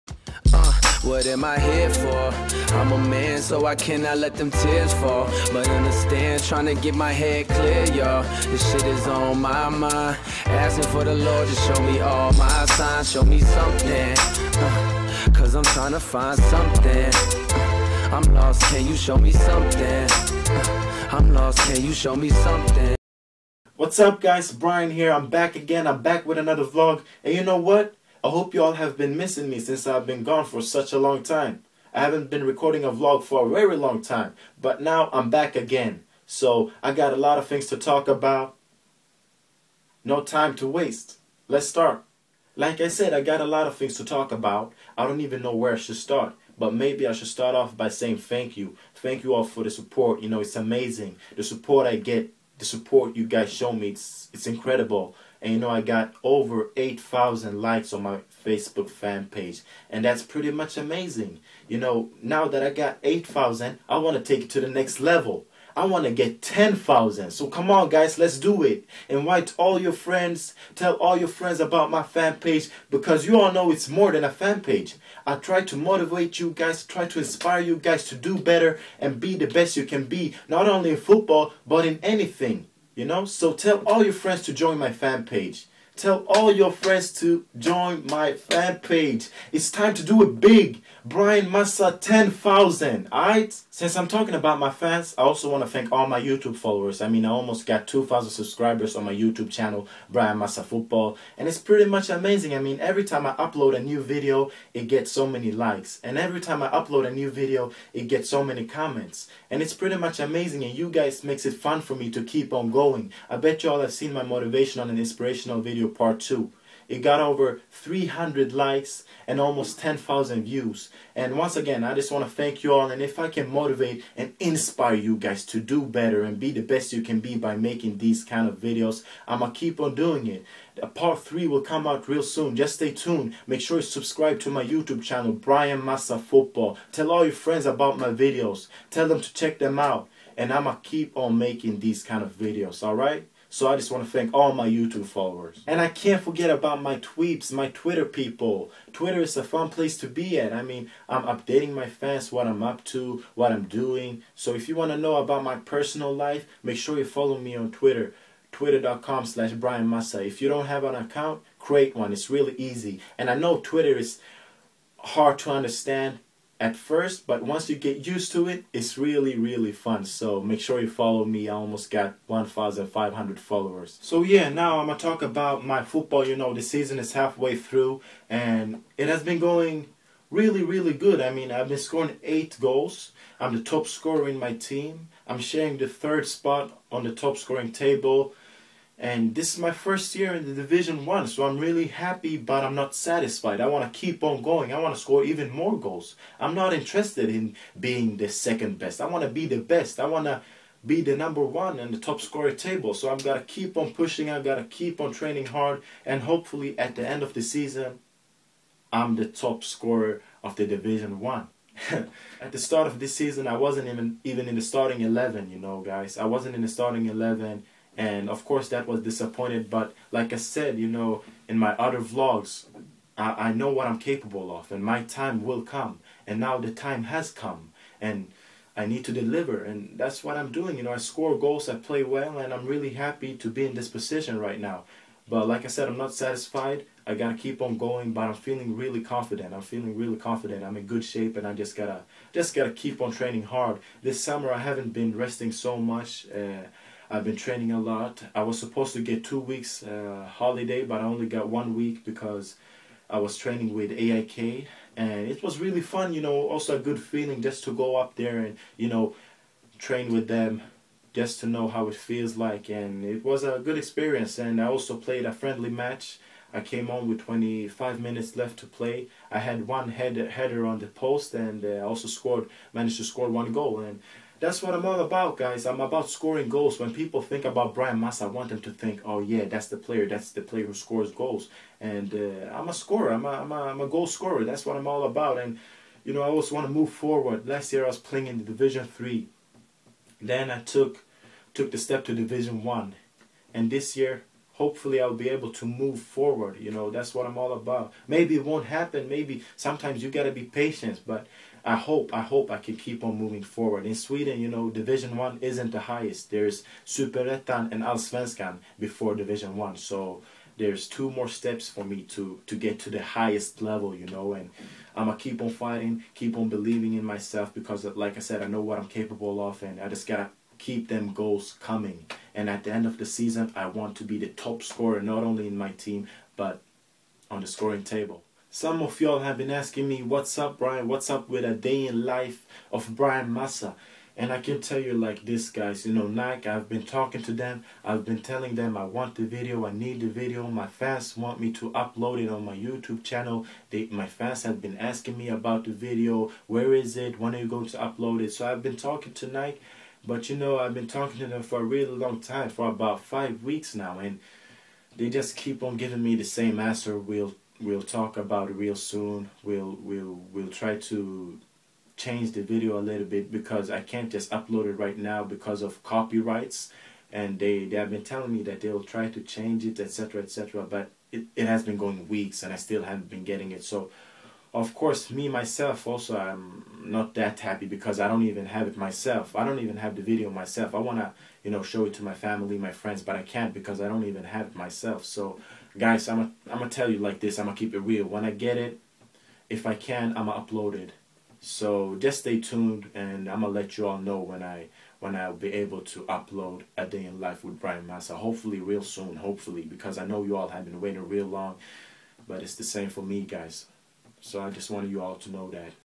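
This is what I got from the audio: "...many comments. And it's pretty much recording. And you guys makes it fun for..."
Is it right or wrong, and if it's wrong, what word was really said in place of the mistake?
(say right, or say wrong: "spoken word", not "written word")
wrong: "amazing", not "recording".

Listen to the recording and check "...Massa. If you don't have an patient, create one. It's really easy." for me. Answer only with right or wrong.
wrong.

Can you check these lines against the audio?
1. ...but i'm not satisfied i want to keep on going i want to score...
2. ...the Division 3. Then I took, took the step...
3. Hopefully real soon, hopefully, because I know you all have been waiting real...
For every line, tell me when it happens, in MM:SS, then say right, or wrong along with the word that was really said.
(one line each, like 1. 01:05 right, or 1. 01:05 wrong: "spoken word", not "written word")
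1. 03:12 right
2. 04:48 right
3. 06:38 right.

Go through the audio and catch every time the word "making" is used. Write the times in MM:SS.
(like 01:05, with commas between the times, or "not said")
02:07, 02:21.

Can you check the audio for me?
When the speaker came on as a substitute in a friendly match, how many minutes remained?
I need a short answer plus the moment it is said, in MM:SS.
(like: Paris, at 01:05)
25, at 04:27.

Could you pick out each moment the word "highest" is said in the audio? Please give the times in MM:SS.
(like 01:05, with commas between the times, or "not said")
05:05, 05:13.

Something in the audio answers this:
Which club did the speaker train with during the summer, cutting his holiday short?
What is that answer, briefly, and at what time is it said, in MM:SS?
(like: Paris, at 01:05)
AIK, at 04:13.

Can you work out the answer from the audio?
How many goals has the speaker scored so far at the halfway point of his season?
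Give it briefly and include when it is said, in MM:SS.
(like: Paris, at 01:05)
8, at 03:02.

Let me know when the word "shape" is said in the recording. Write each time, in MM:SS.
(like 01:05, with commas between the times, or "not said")
04:01.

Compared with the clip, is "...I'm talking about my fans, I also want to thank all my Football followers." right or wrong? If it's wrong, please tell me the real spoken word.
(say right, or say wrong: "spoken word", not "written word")
wrong: "YouTube", not "Football".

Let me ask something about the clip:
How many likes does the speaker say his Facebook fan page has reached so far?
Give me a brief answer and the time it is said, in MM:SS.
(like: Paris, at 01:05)
8,000, at 00:56.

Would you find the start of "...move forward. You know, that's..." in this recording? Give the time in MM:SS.
04:55.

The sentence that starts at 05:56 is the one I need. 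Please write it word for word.
We'll we'll talk about it real soon.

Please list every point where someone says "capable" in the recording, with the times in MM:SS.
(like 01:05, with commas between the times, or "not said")
03:44, 05:18.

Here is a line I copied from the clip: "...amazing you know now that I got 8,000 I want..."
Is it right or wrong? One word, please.
right.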